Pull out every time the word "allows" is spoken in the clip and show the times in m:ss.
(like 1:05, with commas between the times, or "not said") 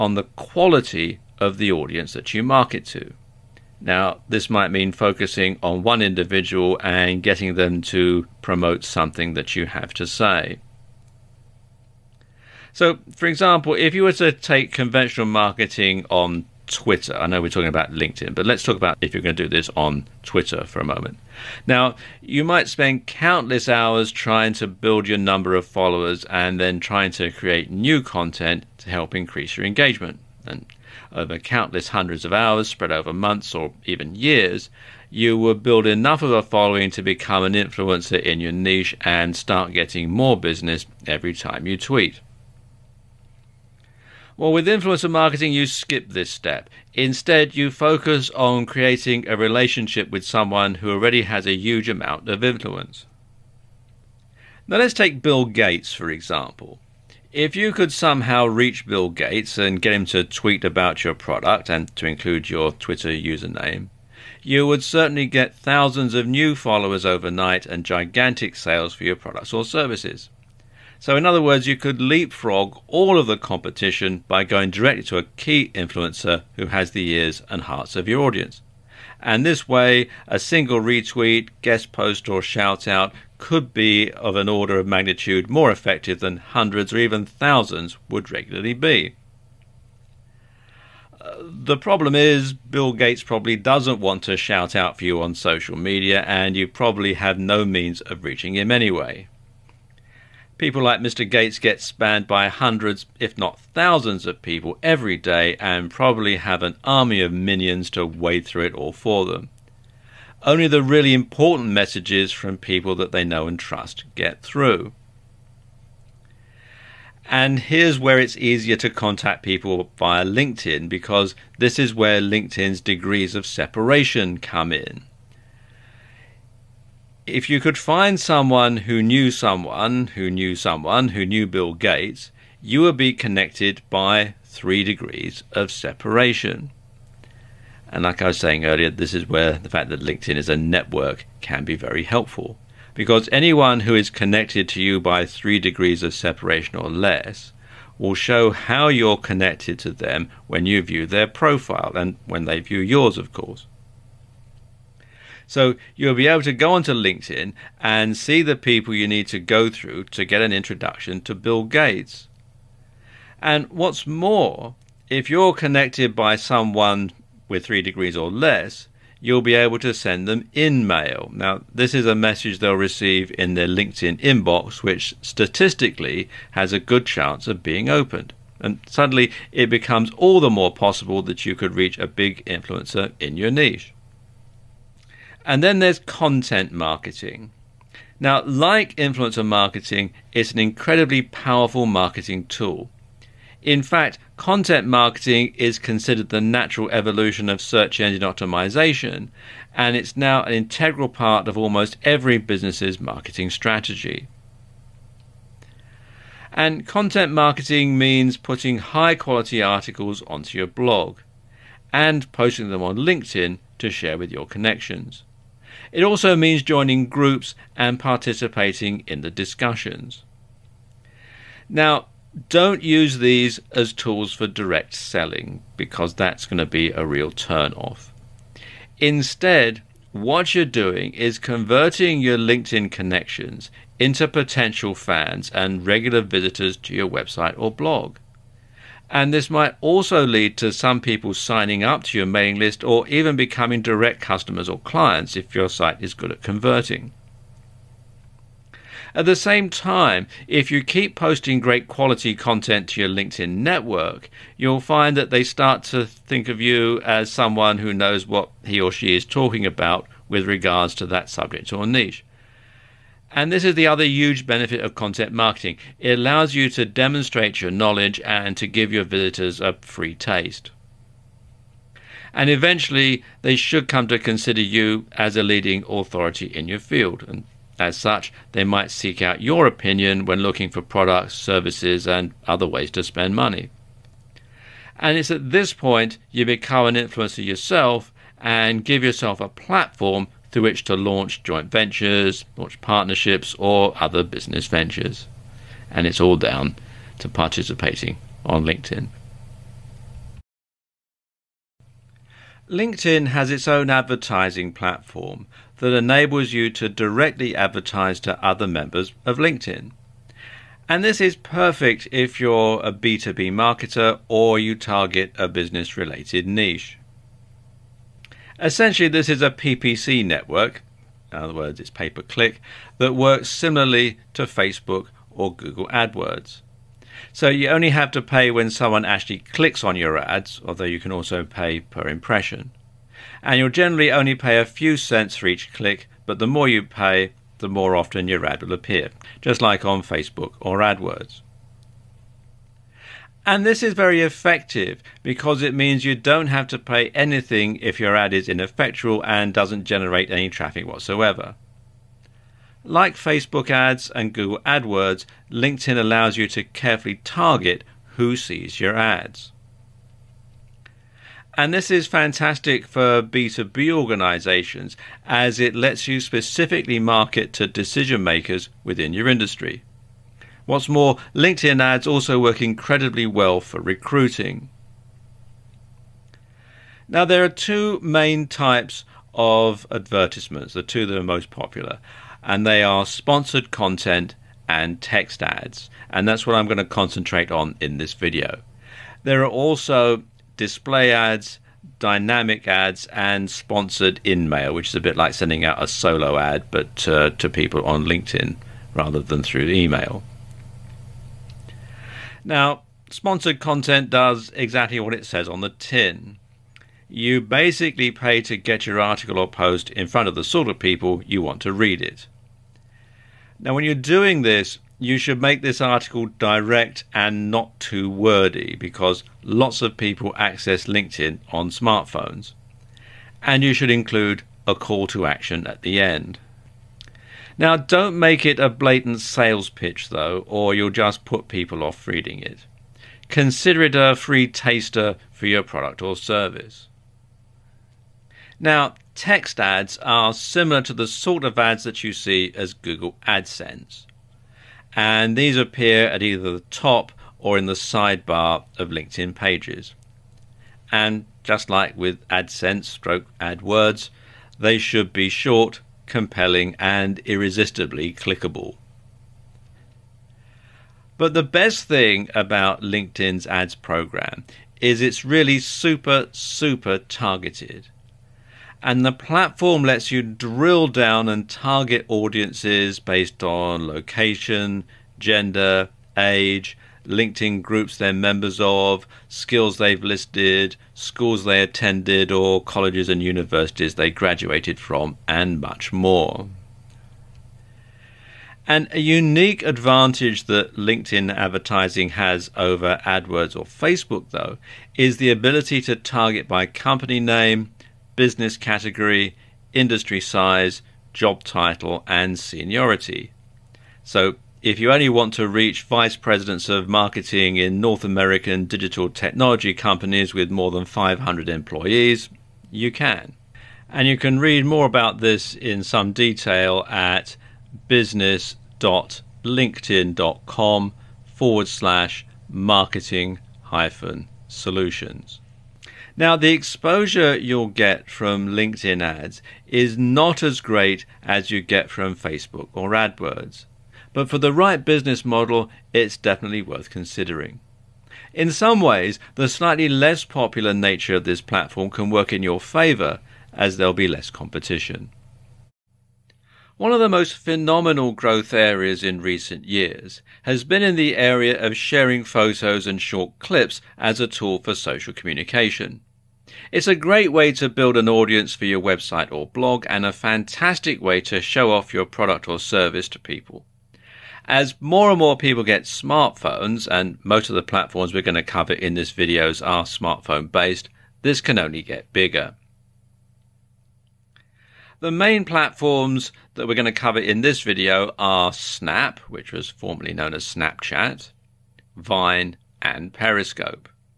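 4:26, 5:55.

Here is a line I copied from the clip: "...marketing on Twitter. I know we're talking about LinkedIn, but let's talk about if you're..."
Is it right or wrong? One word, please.
right.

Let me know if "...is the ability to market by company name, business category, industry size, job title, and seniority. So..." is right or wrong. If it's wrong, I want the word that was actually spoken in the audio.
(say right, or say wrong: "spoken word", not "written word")
wrong: "target", not "market".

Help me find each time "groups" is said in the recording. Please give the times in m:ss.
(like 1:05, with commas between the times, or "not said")
3:37, 7:57.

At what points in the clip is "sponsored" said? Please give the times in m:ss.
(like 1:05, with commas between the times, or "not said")
6:23, 6:33, 6:43.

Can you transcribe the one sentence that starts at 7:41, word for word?
But the best thing about LinkedIn's ads program is it's really super, super targeted.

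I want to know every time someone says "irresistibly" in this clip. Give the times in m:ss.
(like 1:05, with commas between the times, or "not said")
7:37.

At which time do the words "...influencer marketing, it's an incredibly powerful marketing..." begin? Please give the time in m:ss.
3:08.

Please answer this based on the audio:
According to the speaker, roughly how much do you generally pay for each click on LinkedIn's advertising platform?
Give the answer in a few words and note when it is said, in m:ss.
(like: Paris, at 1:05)
a few cents, at 5:34.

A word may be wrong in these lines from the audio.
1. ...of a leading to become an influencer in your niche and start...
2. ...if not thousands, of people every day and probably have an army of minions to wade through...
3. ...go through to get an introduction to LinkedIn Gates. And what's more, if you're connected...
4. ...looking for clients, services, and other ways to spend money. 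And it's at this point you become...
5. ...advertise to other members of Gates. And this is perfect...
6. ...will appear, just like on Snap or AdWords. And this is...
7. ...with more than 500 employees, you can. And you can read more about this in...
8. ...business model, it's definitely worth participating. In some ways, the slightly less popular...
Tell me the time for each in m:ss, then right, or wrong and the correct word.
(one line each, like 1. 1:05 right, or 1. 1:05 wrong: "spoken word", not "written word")
1. 0:36 wrong: "following", not "leading"
2. 1:43 right
3. 2:39 wrong: "Bill", not "LinkedIn"
4. 4:40 wrong: "products", not "clients"
5. 5:07 wrong: "LinkedIn", not "Gates"
6. 5:38 wrong: "Facebook", not "Snap"
7. 8:30 right
8. 8:54 wrong: "considering", not "participating".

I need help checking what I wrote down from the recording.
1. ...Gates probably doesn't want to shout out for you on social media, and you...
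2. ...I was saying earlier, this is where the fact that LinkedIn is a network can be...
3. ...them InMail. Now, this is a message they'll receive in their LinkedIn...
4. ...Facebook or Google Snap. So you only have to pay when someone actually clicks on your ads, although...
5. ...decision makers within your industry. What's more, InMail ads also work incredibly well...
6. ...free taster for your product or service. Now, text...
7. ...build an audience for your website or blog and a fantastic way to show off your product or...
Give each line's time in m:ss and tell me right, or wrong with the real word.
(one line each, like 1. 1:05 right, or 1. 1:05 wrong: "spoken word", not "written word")
1. 1:32 right
2. 2:18 right
3. 2:50 right
4. 5:24 wrong: "AdWords", not "Snap"
5. 6:07 wrong: "LinkedIn", not "InMail"
6. 7:14 right
7. 9:17 right.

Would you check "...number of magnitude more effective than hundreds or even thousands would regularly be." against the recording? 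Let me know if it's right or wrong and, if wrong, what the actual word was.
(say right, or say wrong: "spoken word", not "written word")
wrong: "order", not "number".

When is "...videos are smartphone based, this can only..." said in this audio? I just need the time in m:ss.
9:29.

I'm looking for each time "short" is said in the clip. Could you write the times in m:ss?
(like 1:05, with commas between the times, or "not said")
7:35, 9:13.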